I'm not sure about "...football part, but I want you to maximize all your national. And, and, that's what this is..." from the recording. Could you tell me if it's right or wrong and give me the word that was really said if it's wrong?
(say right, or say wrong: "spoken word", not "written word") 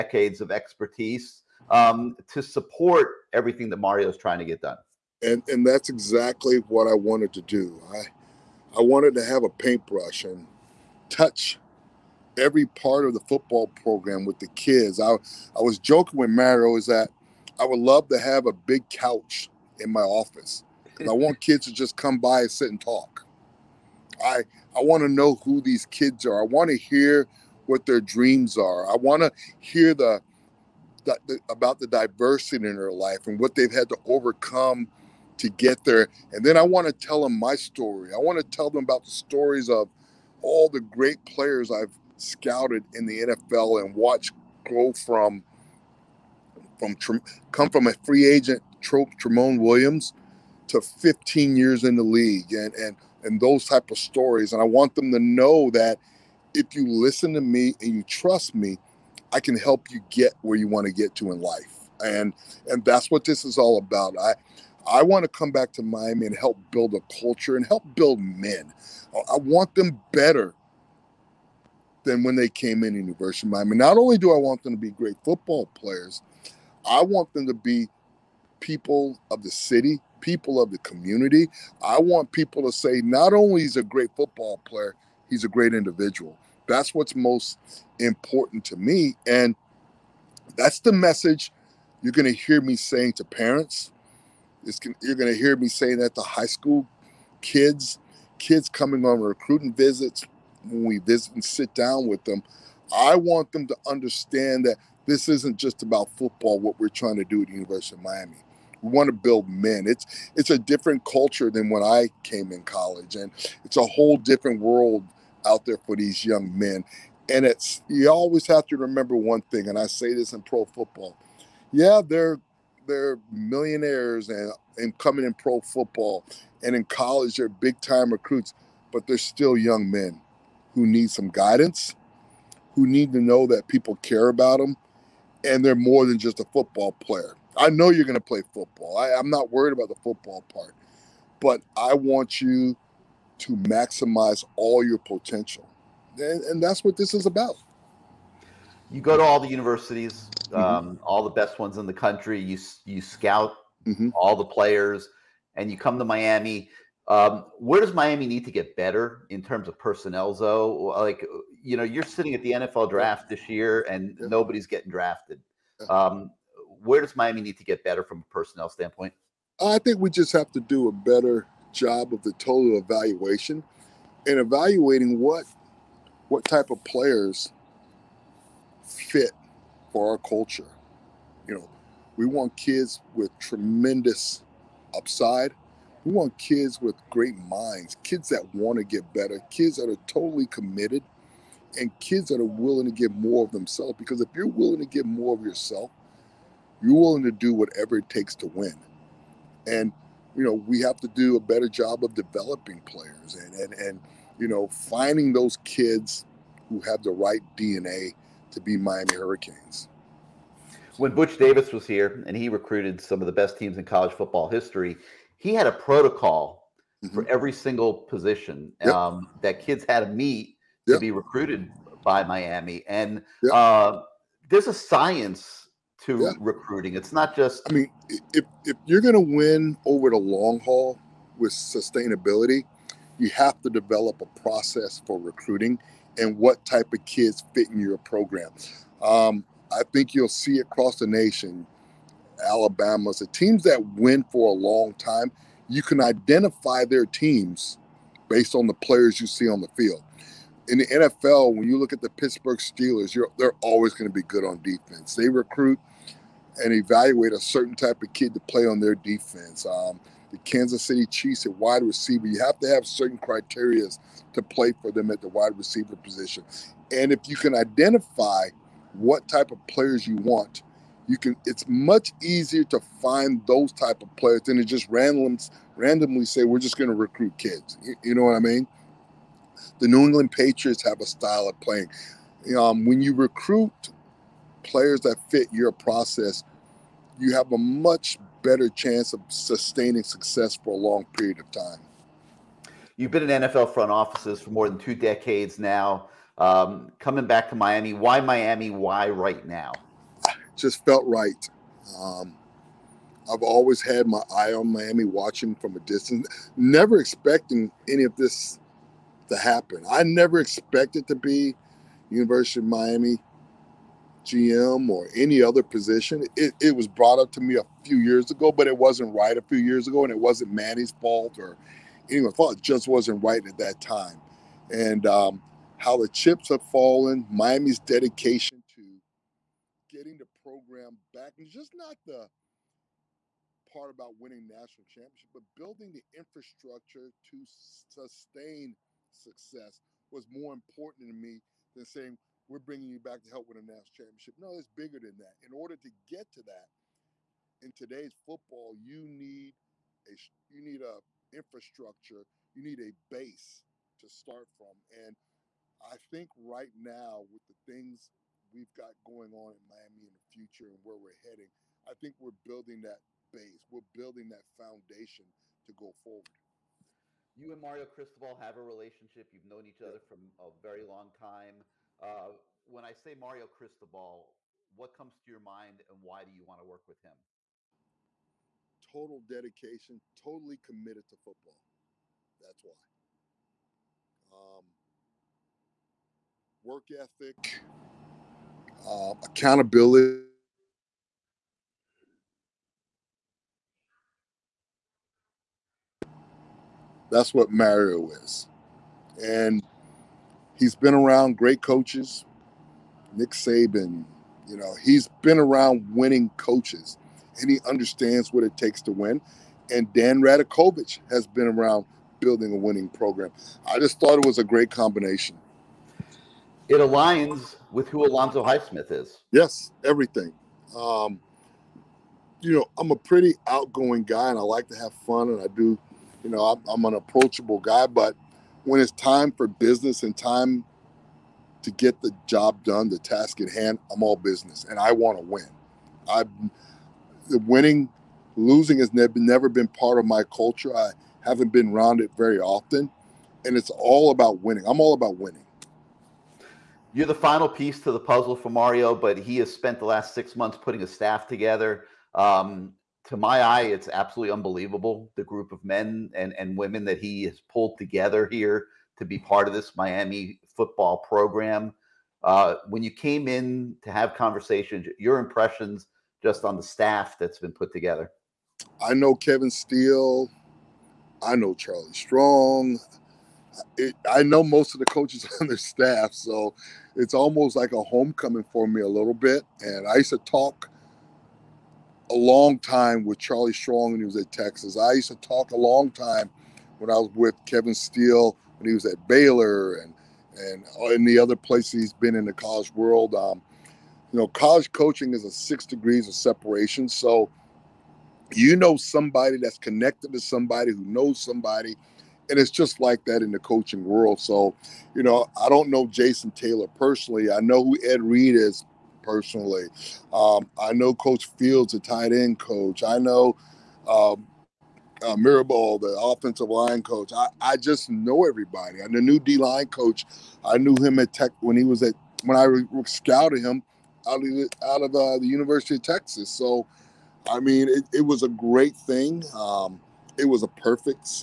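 wrong: "potential", not "national".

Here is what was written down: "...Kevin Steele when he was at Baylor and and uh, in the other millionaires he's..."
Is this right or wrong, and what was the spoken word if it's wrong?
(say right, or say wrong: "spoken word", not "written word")
wrong: "places", not "millionaires".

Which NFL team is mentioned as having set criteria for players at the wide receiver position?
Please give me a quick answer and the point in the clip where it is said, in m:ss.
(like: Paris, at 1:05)
Kansas City Chiefs, at 4:20.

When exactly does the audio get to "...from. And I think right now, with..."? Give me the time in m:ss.
5:54.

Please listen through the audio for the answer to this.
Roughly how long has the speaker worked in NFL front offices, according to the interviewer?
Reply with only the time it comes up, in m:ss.
4:54.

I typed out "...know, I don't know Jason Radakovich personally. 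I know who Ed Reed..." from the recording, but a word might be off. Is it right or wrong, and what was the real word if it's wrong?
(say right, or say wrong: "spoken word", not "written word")
wrong: "Taylor", not "Radakovich".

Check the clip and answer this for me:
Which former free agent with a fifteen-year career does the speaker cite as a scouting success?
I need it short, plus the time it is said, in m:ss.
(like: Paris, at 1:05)
Tramon Williams, at 0:49.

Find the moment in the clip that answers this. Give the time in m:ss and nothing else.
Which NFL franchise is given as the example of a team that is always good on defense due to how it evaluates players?
4:12.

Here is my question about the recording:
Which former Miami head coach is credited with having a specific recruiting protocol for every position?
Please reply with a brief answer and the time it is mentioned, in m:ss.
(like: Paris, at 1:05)
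Butch Davis, at 3:31.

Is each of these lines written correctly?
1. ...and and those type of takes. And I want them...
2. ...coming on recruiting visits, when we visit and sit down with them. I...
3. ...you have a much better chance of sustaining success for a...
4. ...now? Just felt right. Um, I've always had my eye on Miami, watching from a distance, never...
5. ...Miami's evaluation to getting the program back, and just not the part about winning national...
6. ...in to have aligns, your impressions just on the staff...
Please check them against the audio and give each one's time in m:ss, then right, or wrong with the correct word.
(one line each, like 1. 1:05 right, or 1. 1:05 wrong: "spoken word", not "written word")
1. 0:52 wrong: "stories", not "takes"
2. 1:38 right
3. 4:47 right
4. 4:59 right
5. 5:27 wrong: "dedication", not "evaluation"
6. 7:43 wrong: "conversations", not "aligns".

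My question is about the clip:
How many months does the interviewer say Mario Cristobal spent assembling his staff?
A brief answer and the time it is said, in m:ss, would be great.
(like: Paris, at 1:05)
6, at 7:30.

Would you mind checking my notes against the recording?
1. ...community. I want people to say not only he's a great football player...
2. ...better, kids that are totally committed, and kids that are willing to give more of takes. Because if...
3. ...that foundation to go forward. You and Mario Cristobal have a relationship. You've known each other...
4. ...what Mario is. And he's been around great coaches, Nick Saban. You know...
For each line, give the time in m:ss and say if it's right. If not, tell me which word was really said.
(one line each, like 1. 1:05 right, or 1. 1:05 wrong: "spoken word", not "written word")
1. 1:20 right
2. 3:09 wrong: "themselves", not "takes"
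3. 6:04 right
4. 6:37 right.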